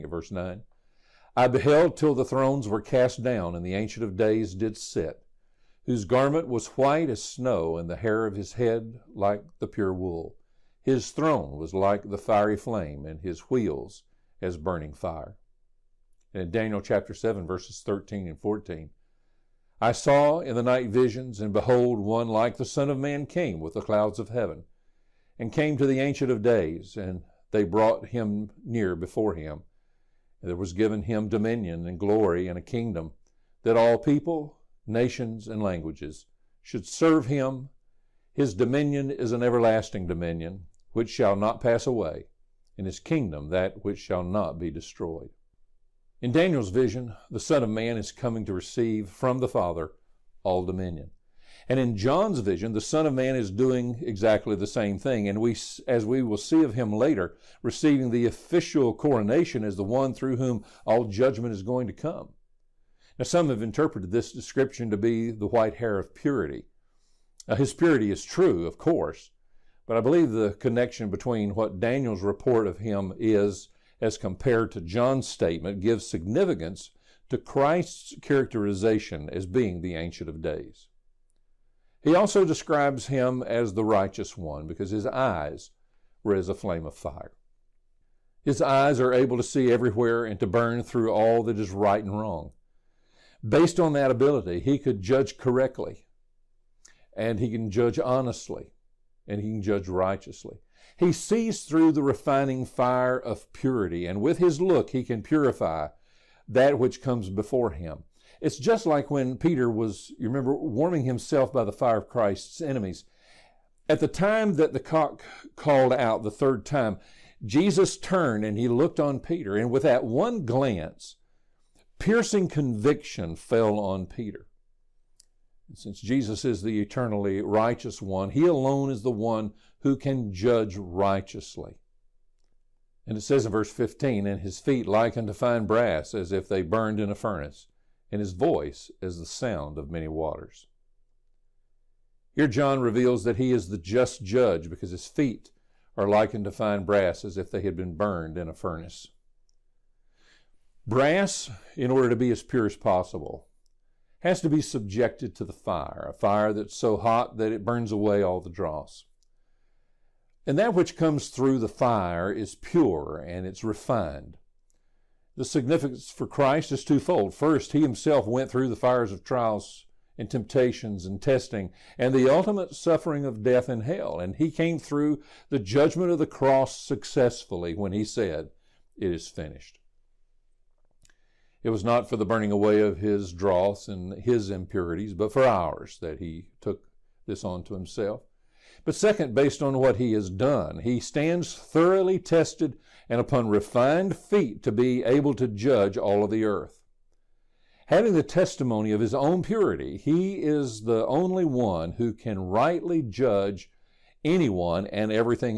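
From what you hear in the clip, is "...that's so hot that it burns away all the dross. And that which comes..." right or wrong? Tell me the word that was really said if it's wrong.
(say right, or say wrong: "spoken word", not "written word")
right.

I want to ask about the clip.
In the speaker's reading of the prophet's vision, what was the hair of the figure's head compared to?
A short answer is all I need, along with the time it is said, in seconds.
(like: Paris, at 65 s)
Pure wool, at 9 s.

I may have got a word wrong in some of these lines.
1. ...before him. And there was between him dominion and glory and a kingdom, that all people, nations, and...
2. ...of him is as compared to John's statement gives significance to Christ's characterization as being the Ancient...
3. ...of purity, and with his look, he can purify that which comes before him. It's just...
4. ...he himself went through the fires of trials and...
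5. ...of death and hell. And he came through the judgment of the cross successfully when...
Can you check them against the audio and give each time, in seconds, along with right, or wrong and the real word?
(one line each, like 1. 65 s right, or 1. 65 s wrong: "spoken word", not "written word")
1. 28 s wrong: "given", not "between"
2. 72 s right
3. 103 s right
4. 167 s right
5. 173 s right.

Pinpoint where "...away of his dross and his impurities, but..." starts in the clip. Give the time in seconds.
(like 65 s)
182 s.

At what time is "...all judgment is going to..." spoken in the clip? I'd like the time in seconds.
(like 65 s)
60 s.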